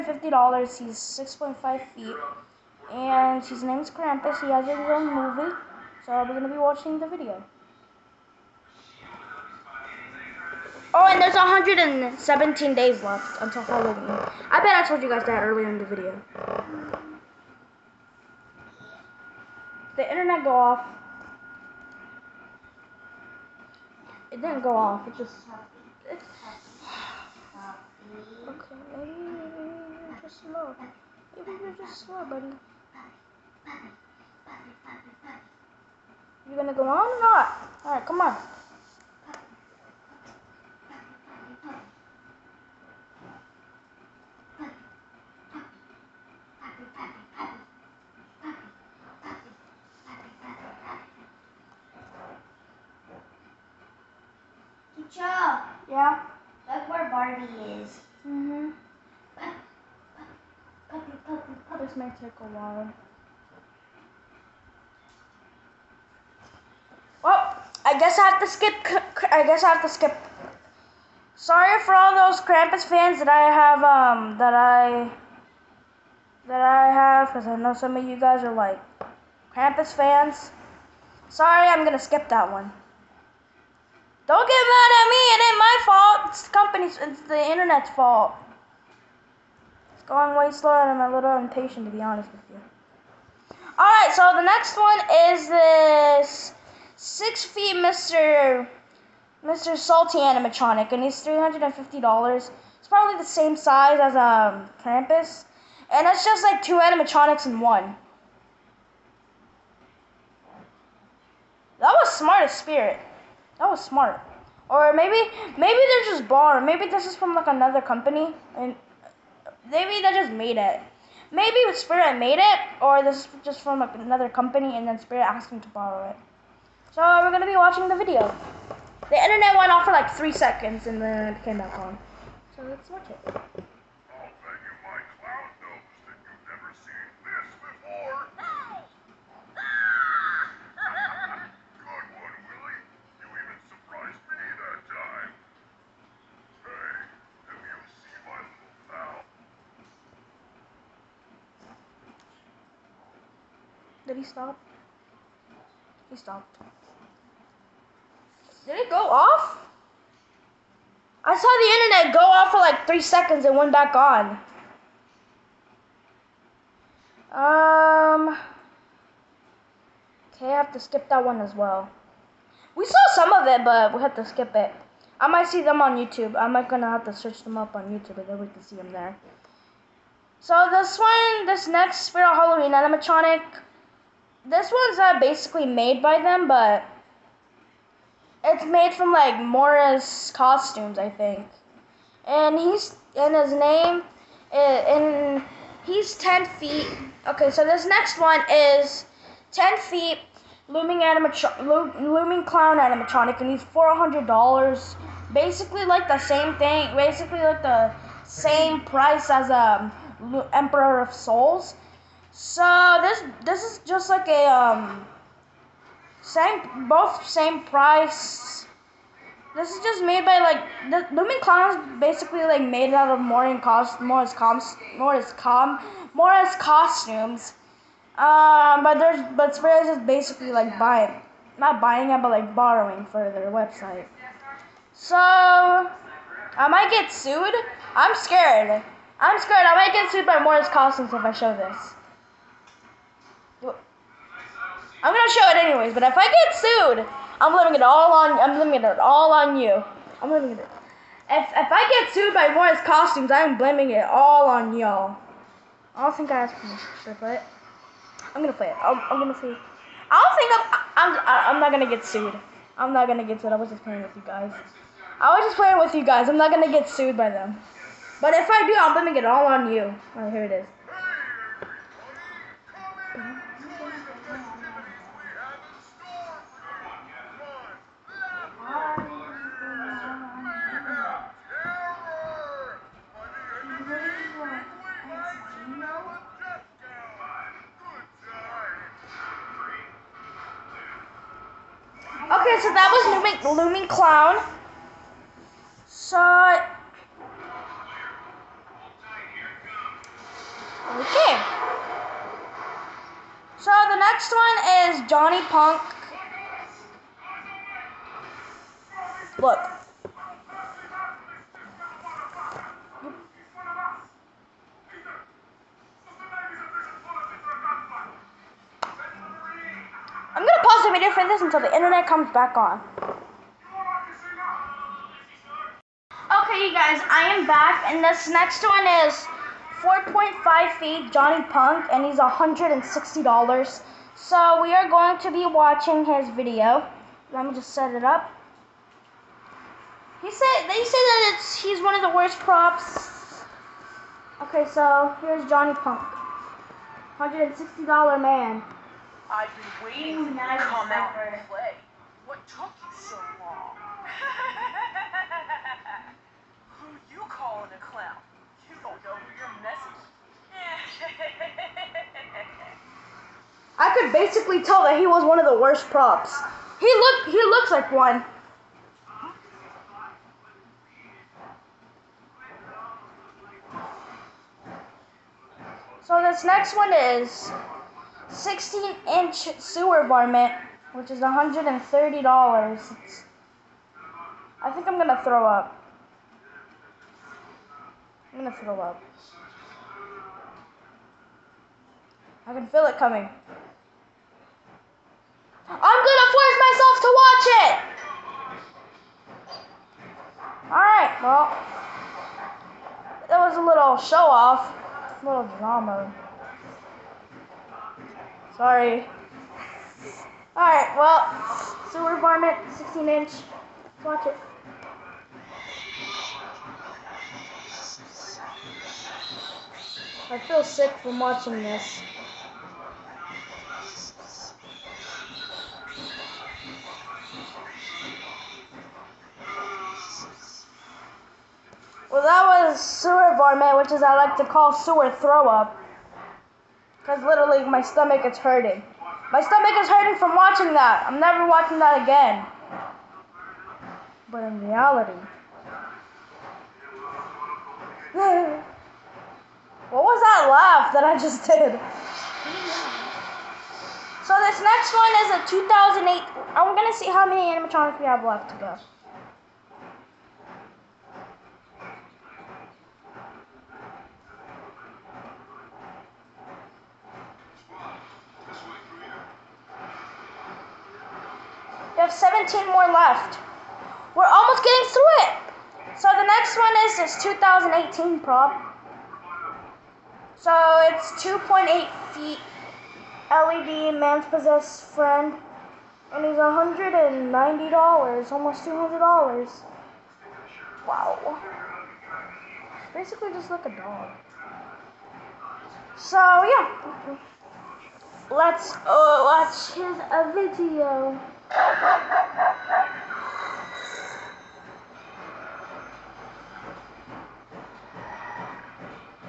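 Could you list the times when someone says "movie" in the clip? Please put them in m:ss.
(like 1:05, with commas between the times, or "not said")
0:05.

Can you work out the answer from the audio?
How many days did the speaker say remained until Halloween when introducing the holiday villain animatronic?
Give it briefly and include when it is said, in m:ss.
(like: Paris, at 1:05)
117, at 0:11.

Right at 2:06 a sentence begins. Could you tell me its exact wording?
So we're gonna be watching the video.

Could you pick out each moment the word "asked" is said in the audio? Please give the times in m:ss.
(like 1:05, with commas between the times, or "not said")
2:05, 4:16.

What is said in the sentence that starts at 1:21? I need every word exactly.
Sorry, I'm gonna skip that one.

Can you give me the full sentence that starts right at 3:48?
Um, but there's but Spurs is basically like buying not buying it but like borrowing for their website.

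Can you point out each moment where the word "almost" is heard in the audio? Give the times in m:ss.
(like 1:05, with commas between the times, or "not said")
7:54, 8:08.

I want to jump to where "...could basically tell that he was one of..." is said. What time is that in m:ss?
6:03.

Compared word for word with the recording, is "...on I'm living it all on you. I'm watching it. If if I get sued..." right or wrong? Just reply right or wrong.
wrong.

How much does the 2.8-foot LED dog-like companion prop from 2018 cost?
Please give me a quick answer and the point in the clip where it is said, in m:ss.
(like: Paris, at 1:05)
$190, at 8:06.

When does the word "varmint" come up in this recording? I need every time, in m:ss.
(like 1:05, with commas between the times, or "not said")
6:20, 6:52, 7:13.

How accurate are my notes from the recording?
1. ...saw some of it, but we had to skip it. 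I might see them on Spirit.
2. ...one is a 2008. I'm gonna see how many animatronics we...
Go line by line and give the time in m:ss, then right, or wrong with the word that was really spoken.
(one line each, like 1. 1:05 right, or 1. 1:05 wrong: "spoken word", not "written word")
1. 2:52 wrong: "YouTube", not "Spirit"
2. 7:34 right.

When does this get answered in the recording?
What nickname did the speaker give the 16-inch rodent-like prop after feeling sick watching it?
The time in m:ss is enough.
7:14.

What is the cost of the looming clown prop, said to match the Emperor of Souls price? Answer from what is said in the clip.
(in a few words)
$400.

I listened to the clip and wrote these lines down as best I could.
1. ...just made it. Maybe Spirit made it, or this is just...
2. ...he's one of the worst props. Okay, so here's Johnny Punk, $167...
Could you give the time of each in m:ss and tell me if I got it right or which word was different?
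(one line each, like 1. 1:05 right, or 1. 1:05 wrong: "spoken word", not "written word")
1. 2:00 right
2. 5:41 wrong: "160", not "167".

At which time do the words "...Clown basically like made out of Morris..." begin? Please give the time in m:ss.
3:41.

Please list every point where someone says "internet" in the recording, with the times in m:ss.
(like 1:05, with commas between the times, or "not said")
0:20, 1:27, 2:09, 2:41, 5:21.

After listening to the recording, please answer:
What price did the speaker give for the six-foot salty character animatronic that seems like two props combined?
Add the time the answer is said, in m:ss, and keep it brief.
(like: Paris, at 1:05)
$350, at 1:41.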